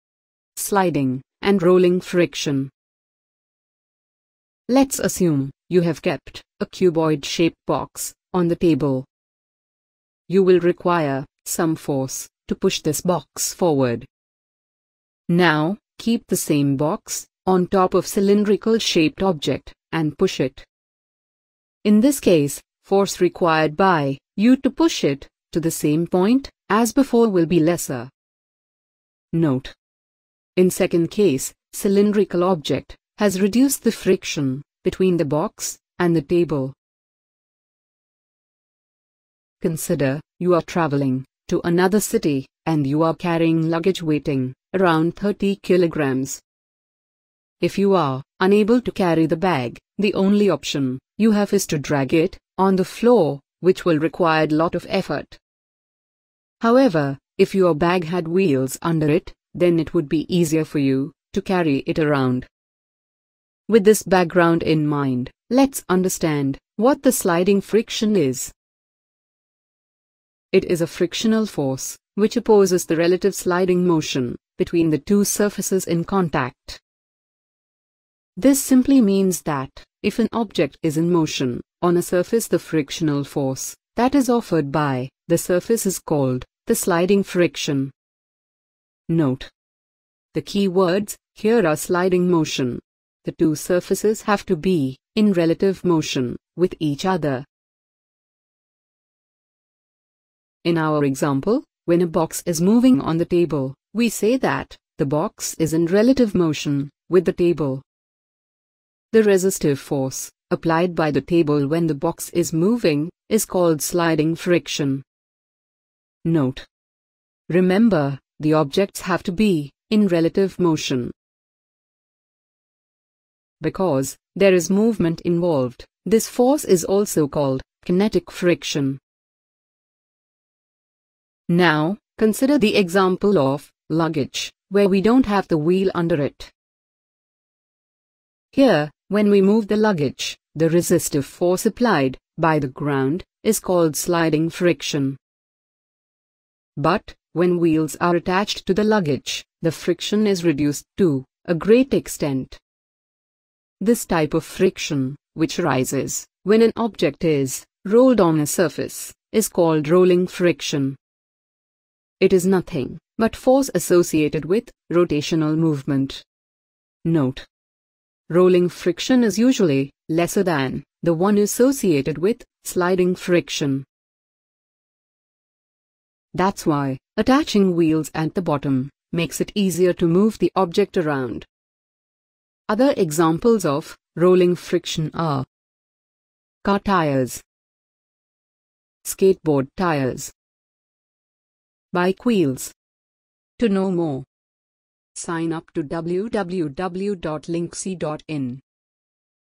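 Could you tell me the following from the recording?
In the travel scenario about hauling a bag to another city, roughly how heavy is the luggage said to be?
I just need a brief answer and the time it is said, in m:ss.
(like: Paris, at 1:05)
30 kilograms, at 0:45.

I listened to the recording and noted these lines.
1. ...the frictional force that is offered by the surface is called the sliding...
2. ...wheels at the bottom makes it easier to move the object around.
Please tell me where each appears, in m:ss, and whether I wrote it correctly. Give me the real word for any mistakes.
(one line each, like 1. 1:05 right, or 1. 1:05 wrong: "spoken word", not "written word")
1. 1:22 right
2. 2:57 right.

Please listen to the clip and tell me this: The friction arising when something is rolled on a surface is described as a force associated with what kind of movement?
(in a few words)
rotational movement.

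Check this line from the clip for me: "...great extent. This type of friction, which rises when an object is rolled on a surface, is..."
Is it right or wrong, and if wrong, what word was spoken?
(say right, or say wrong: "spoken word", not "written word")
right.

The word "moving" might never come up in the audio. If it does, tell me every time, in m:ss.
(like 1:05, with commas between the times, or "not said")
1:42, 1:52.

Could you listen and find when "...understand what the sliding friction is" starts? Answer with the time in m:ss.
1:05.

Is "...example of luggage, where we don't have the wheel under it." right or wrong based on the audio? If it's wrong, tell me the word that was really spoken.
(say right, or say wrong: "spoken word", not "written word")
right.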